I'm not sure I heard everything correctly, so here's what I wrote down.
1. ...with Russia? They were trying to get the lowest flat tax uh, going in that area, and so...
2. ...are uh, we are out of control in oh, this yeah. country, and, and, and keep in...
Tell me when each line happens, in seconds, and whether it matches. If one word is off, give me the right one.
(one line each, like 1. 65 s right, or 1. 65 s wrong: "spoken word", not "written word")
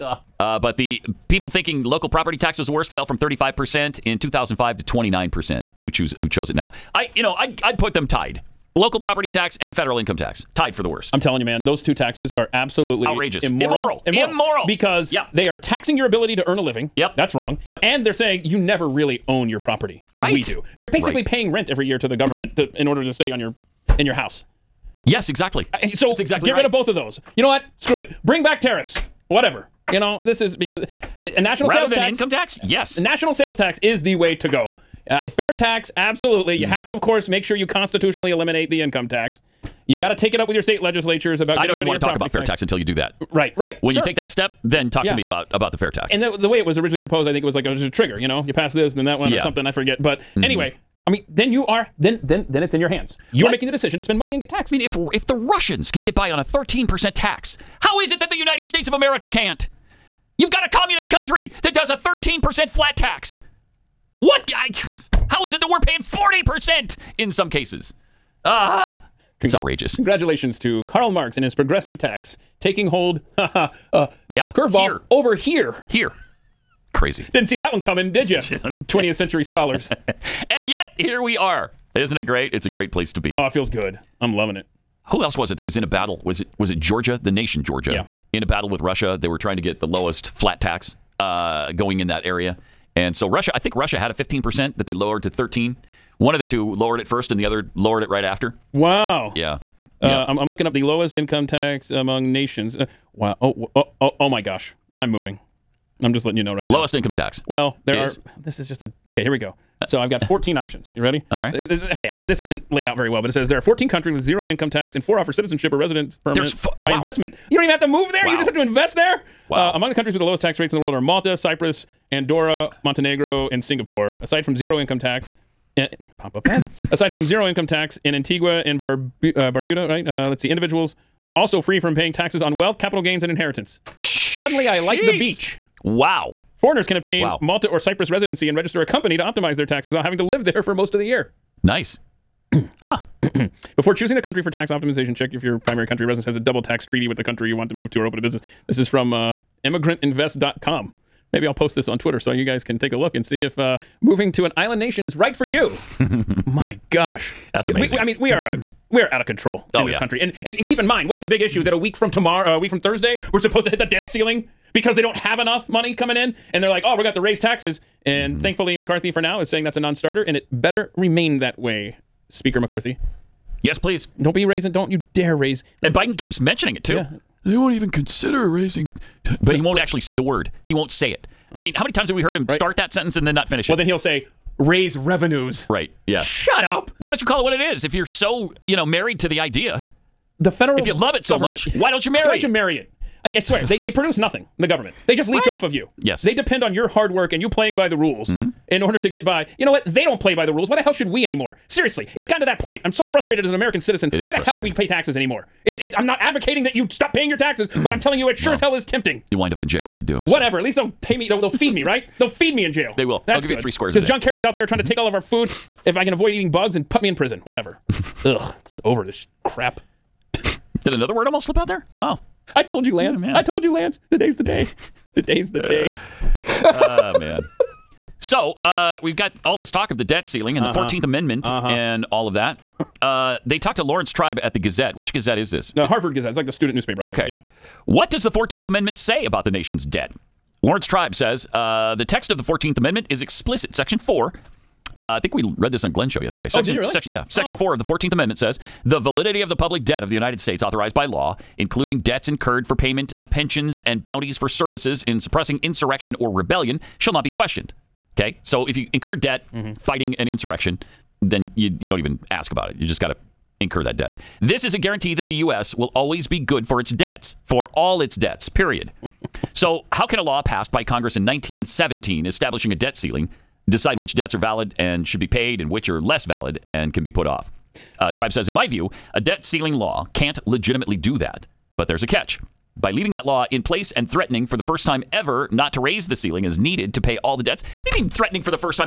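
1. 88 s right
2. 158 s right.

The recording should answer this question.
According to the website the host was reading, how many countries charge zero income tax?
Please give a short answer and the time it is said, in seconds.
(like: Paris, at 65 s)
14, at 113 s.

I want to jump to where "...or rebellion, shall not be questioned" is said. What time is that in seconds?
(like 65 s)
256 s.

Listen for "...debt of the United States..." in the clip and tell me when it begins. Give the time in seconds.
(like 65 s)
249 s.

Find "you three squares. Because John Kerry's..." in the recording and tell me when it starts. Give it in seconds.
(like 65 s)
213 s.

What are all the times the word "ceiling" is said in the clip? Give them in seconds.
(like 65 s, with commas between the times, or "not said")
164 s, 230 s, 272 s, 279 s, 286 s.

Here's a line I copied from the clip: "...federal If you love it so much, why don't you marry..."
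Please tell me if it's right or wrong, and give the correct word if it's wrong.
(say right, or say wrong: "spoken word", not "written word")
right.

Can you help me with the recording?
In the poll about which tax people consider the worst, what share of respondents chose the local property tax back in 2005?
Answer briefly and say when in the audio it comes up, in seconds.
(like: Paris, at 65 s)
35%, at 3 s.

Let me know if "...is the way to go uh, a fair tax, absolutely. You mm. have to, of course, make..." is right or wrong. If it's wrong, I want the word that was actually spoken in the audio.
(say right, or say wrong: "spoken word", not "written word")
right.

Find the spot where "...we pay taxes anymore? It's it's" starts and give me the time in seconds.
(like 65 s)
204 s.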